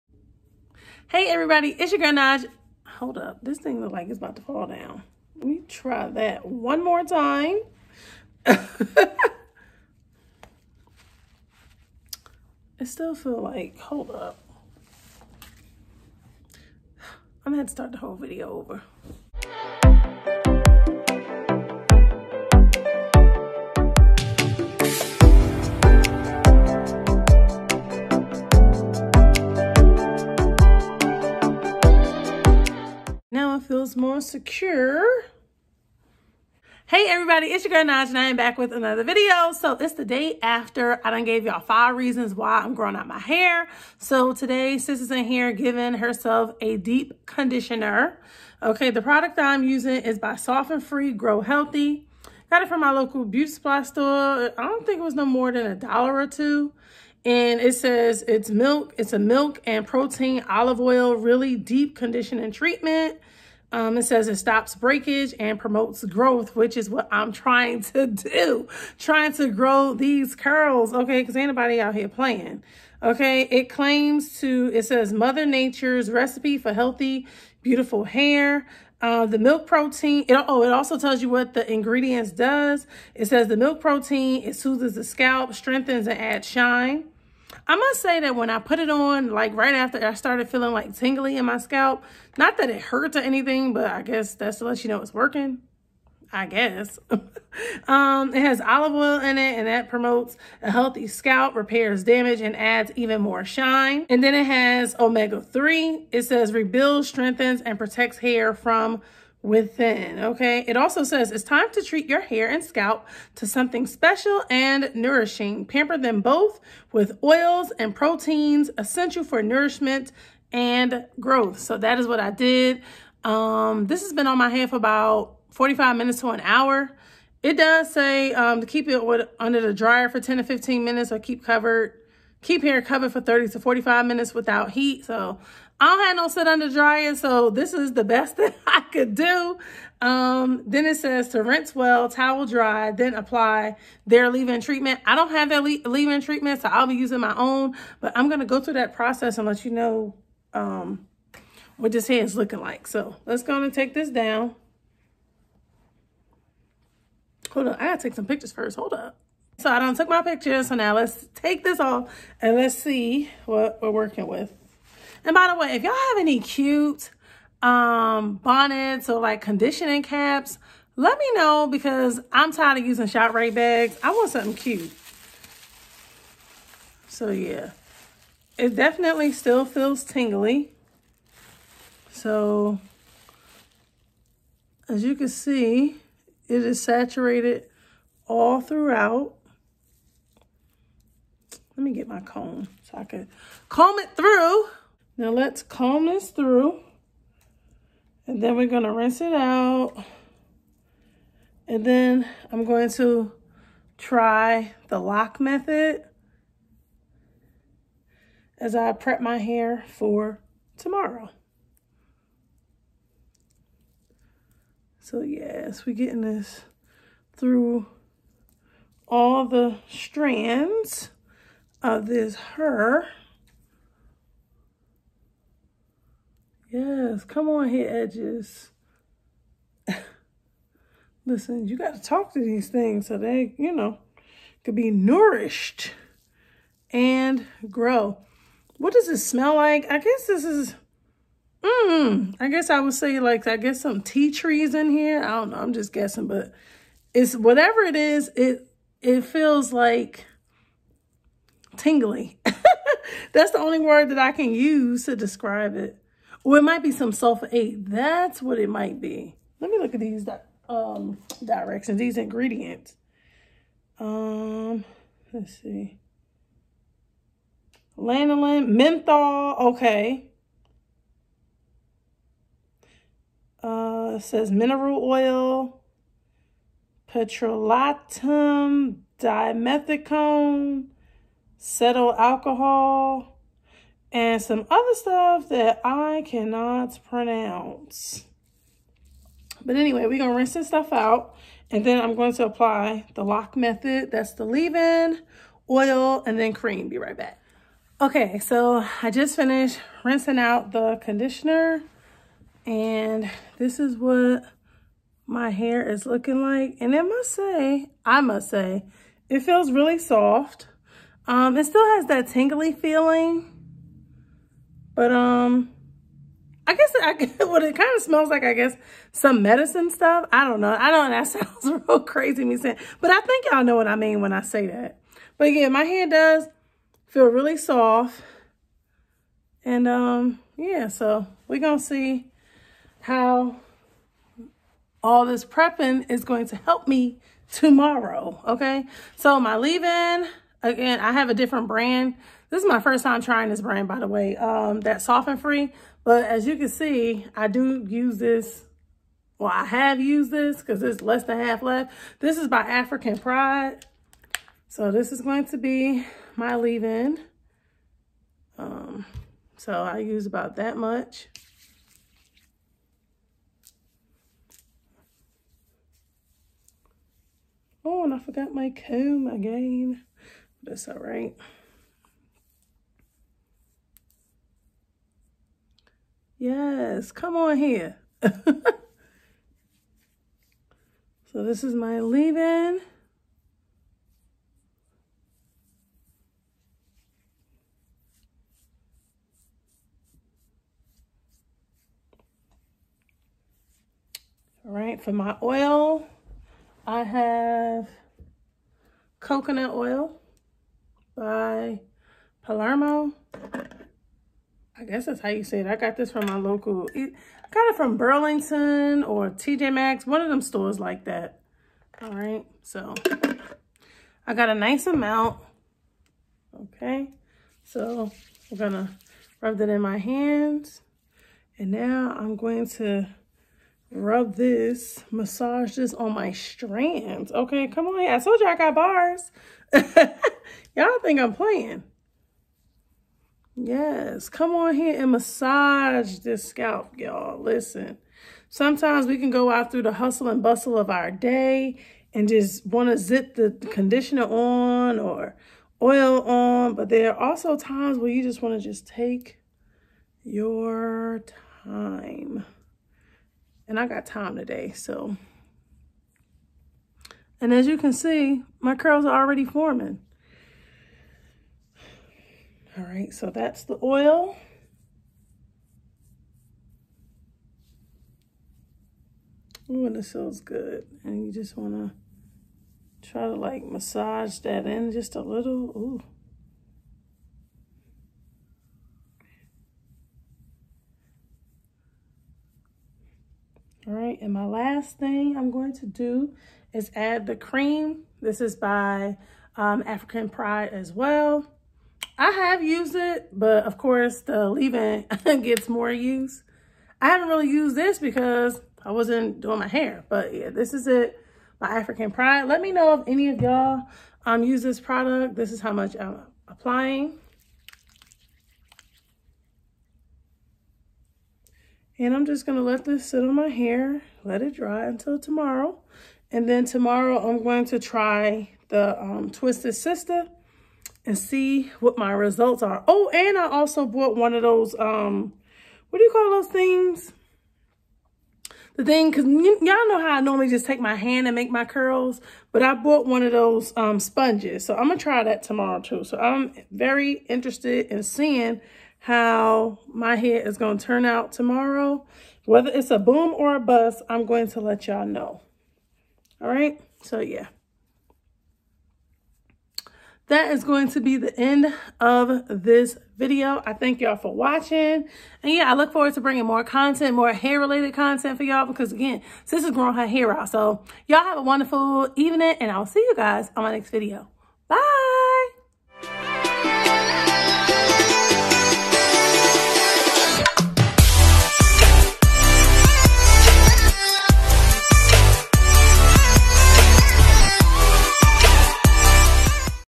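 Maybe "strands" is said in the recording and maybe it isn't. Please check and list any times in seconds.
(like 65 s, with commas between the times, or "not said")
219 s, 426 s.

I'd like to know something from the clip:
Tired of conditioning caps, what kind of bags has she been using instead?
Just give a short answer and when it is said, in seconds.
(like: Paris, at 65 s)
ShopRite bags, at 173 s.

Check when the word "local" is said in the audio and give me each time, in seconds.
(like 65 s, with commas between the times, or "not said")
52 s, 406 s.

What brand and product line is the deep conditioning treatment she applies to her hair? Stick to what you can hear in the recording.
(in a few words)
Sof N' Free Grow Healthy.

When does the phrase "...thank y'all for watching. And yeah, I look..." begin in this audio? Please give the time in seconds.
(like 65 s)
553 s.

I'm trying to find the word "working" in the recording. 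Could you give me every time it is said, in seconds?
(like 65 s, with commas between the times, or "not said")
95 s, 163 s.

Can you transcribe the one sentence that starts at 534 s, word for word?
So I'm going to try that tomorrow too.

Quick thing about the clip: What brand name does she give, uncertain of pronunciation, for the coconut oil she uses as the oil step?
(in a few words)
Palermo.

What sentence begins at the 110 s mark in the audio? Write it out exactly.
It also says it's time to treat your hair and scalp to something special and nourishing.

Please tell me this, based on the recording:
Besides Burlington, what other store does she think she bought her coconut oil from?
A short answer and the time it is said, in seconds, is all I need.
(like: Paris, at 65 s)
TJ Maxx, at 409 s.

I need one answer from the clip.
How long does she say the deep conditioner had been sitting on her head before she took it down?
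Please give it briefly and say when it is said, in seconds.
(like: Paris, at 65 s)
45 minutes to an hour, at 125 s.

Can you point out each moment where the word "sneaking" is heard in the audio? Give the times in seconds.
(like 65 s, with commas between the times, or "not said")
not said.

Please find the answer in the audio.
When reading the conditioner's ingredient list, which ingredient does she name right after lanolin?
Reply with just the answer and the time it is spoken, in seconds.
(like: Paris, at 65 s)
menthol, at 268 s.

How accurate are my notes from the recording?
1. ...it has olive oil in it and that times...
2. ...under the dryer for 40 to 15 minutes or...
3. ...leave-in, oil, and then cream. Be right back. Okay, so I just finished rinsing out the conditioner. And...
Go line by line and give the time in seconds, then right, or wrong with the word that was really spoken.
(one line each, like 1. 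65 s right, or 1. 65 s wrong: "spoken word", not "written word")
1. 98 s wrong: "promotes", not "times"
2. 129 s wrong: "10", not "40"
3. 294 s right.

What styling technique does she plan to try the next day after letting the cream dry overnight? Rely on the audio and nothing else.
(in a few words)
Twisted Sister.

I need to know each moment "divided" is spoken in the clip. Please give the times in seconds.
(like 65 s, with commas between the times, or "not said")
not said.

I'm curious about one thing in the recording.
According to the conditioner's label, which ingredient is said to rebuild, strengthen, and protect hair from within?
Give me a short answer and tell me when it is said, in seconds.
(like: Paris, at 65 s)
omega-3, at 104 s.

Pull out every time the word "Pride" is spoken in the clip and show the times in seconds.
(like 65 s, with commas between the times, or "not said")
353 s, 490 s, 502 s.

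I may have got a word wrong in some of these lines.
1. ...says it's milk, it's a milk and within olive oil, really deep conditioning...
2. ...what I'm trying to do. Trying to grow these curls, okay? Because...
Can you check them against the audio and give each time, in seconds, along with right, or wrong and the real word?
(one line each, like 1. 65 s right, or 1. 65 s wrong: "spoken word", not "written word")
1. 57 s wrong: "protein", not "within"
2. 66 s right.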